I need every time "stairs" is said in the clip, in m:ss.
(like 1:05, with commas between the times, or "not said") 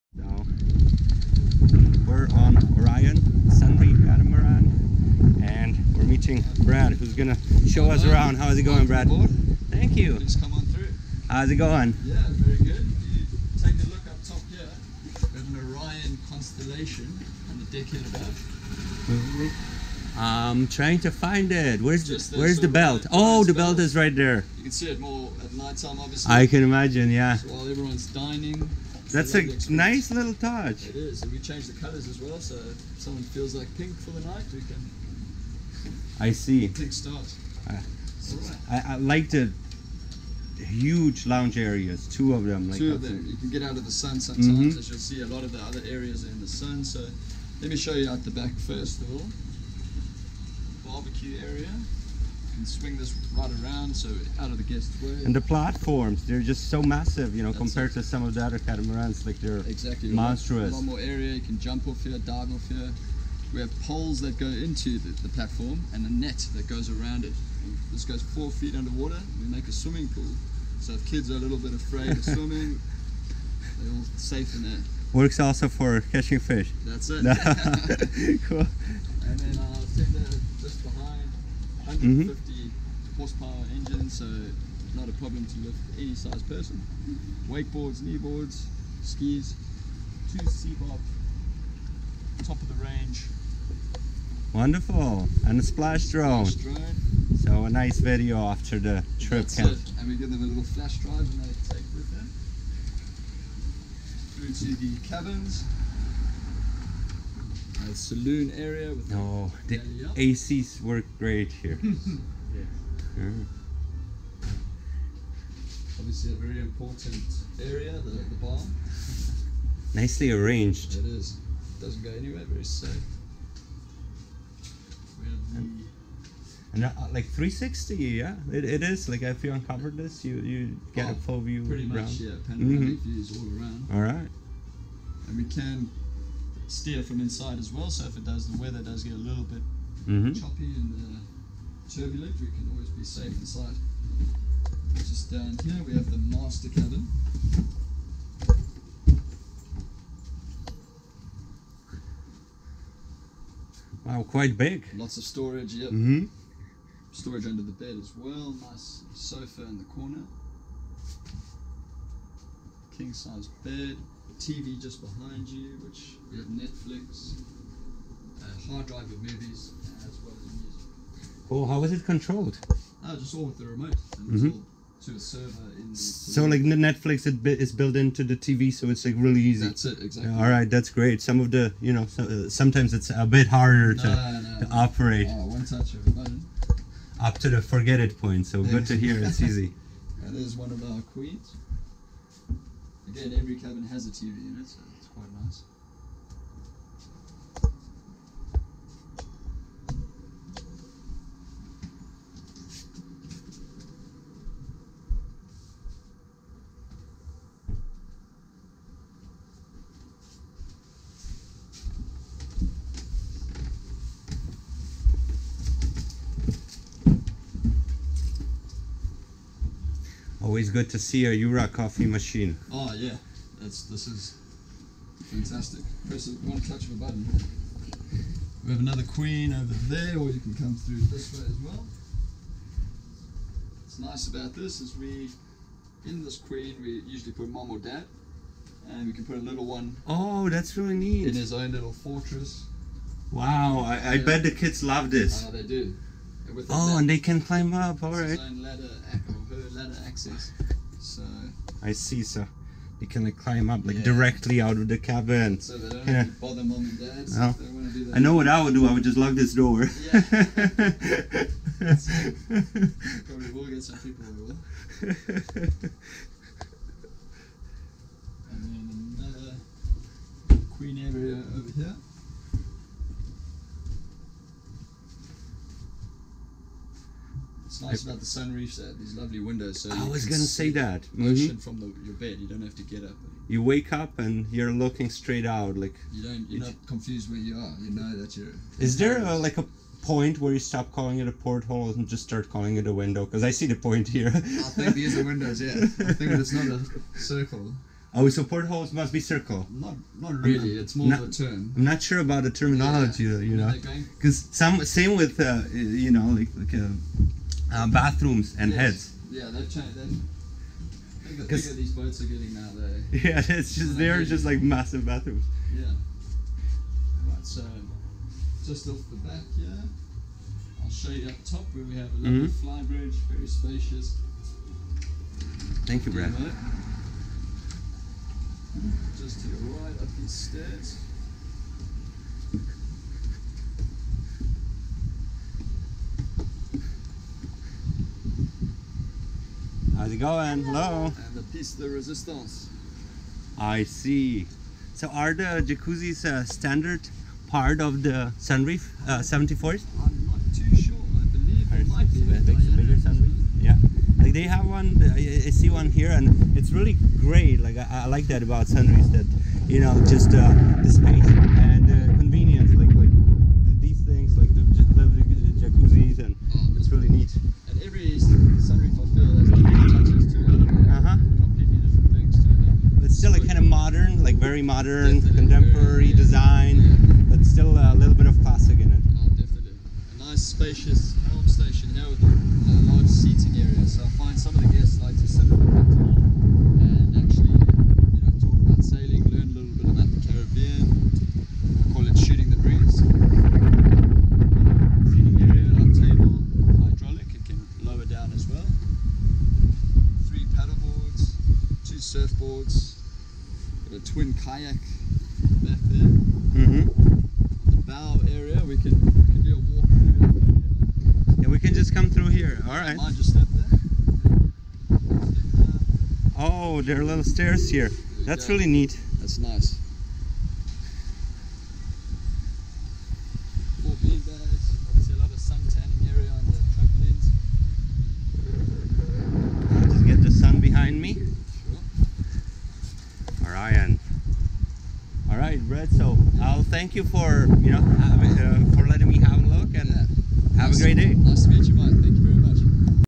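5:30, 6:57.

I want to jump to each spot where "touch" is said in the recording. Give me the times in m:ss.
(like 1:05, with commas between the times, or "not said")
0:30, 3:05, 3:46.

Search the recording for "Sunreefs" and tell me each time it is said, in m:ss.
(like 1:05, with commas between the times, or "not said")
4:38, 5:48, 5:52, 5:58.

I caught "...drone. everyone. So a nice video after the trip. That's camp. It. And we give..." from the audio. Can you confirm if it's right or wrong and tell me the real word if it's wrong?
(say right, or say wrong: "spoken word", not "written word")
wrong: "drone", not "everyone".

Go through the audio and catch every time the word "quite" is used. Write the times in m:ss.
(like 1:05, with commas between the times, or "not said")
2:34, 3:15.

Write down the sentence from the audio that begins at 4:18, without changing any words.
I would just lock this door.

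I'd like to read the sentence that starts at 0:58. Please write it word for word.
to some of the other catamarans.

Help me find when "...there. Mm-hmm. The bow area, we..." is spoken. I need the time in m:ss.
6:45.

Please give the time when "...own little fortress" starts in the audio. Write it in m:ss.
4:01.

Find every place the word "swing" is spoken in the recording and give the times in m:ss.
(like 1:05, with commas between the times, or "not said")
0:52.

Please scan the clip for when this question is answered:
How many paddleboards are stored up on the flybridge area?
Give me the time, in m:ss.
6:40.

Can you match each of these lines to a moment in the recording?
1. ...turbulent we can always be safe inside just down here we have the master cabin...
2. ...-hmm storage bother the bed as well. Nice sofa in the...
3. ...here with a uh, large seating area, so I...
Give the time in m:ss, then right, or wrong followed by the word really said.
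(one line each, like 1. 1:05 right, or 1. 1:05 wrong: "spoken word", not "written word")
1. 2:21 right
2. 2:36 wrong: "under", not "bother"
3. 6:21 right.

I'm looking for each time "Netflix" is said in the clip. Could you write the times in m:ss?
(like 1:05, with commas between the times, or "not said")
2:46, 2:56.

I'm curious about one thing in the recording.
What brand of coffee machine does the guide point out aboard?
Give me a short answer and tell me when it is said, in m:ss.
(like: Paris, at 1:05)
Jura, at 3:41.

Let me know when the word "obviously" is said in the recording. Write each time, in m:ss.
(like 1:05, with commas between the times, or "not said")
0:25, 1:55.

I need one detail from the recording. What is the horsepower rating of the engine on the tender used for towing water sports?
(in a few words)
150.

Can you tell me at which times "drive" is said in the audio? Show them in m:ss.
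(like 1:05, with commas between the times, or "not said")
1:40, 2:48.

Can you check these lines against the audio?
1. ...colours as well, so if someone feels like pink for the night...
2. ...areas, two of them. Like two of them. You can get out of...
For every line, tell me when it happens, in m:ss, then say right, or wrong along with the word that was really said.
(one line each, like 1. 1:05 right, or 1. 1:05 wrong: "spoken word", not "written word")
1. 0:31 right
2. 0:41 right.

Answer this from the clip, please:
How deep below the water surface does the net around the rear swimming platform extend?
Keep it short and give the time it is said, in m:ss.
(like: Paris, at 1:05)
4 feet, at 1:08.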